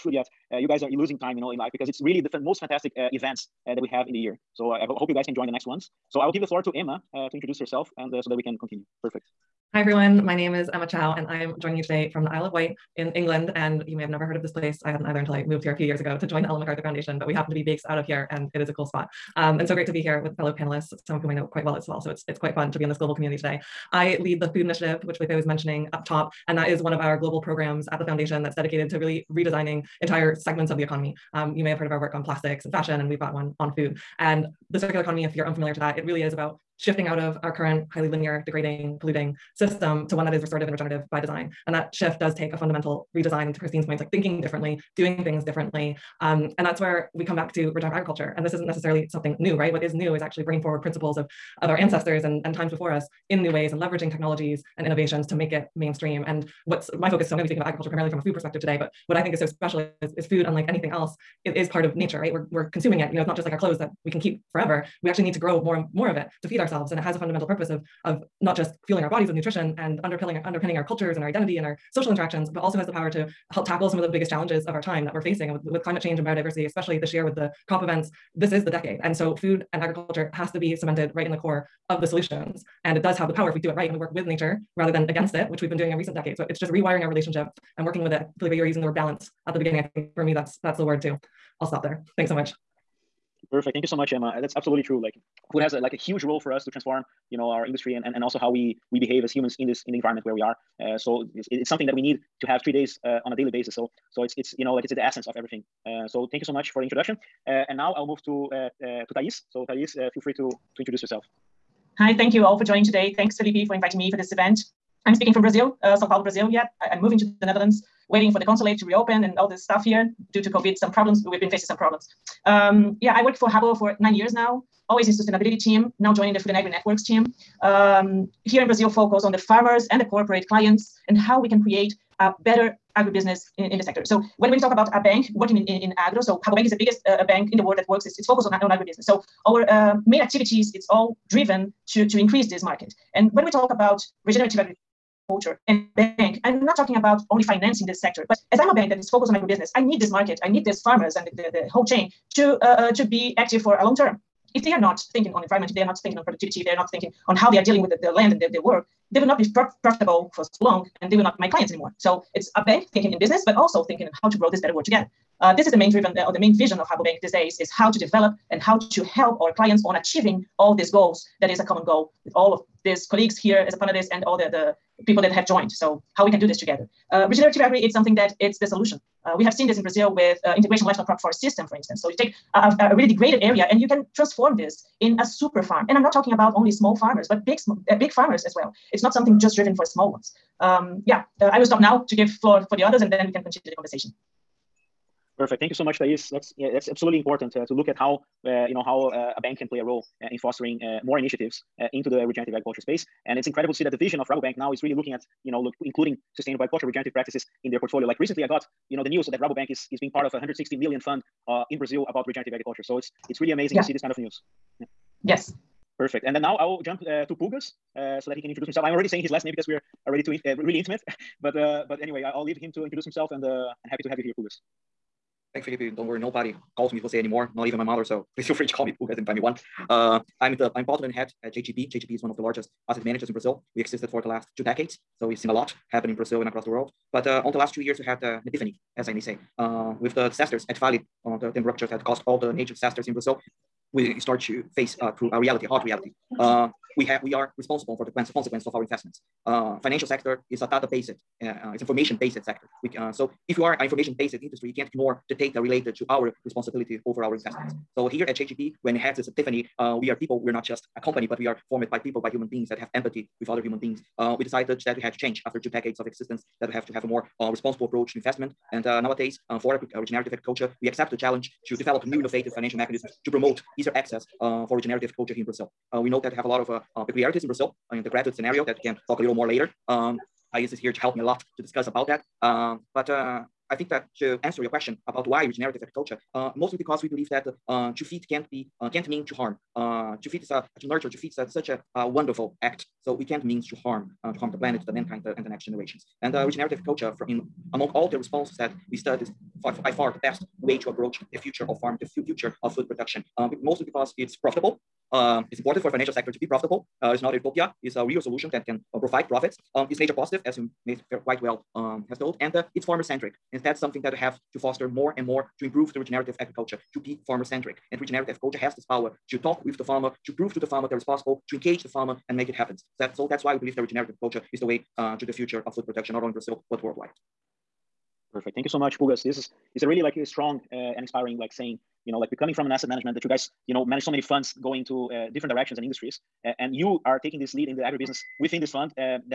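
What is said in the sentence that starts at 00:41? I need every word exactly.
And that shift does take a fundamental redesign.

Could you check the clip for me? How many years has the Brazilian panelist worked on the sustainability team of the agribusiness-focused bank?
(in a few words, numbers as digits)
9.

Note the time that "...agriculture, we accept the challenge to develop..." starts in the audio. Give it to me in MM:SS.
04:30.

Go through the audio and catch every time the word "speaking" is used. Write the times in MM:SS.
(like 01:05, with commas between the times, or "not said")
00:57, 01:55.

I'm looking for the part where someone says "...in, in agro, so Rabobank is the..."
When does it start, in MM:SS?
02:15.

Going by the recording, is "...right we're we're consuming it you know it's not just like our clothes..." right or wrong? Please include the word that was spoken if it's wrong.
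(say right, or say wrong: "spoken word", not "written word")
right.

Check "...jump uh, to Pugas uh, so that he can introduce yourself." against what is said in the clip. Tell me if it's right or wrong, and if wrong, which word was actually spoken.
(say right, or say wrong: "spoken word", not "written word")
wrong: "himself", not "yourself".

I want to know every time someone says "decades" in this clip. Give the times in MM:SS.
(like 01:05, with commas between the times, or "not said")
01:18, 01:26, 03:54, 04:25.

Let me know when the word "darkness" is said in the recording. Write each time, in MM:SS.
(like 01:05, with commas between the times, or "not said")
not said.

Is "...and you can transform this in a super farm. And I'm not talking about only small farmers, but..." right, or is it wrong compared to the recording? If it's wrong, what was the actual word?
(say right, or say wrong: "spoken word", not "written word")
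right.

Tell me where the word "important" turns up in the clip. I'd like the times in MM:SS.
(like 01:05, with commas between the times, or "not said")
03:17, 05:05.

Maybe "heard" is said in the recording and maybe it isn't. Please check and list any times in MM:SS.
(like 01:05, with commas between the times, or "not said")
00:14, 00:31.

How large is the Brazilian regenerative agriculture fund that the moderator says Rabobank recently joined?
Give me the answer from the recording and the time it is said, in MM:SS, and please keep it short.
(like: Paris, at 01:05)
160 million, at 03:30.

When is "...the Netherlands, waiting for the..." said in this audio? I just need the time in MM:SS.
01:57.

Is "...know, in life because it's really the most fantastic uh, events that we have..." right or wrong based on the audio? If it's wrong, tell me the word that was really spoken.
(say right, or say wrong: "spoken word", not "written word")
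right.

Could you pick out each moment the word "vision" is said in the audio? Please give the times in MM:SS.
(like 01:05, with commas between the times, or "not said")
02:46, 03:23.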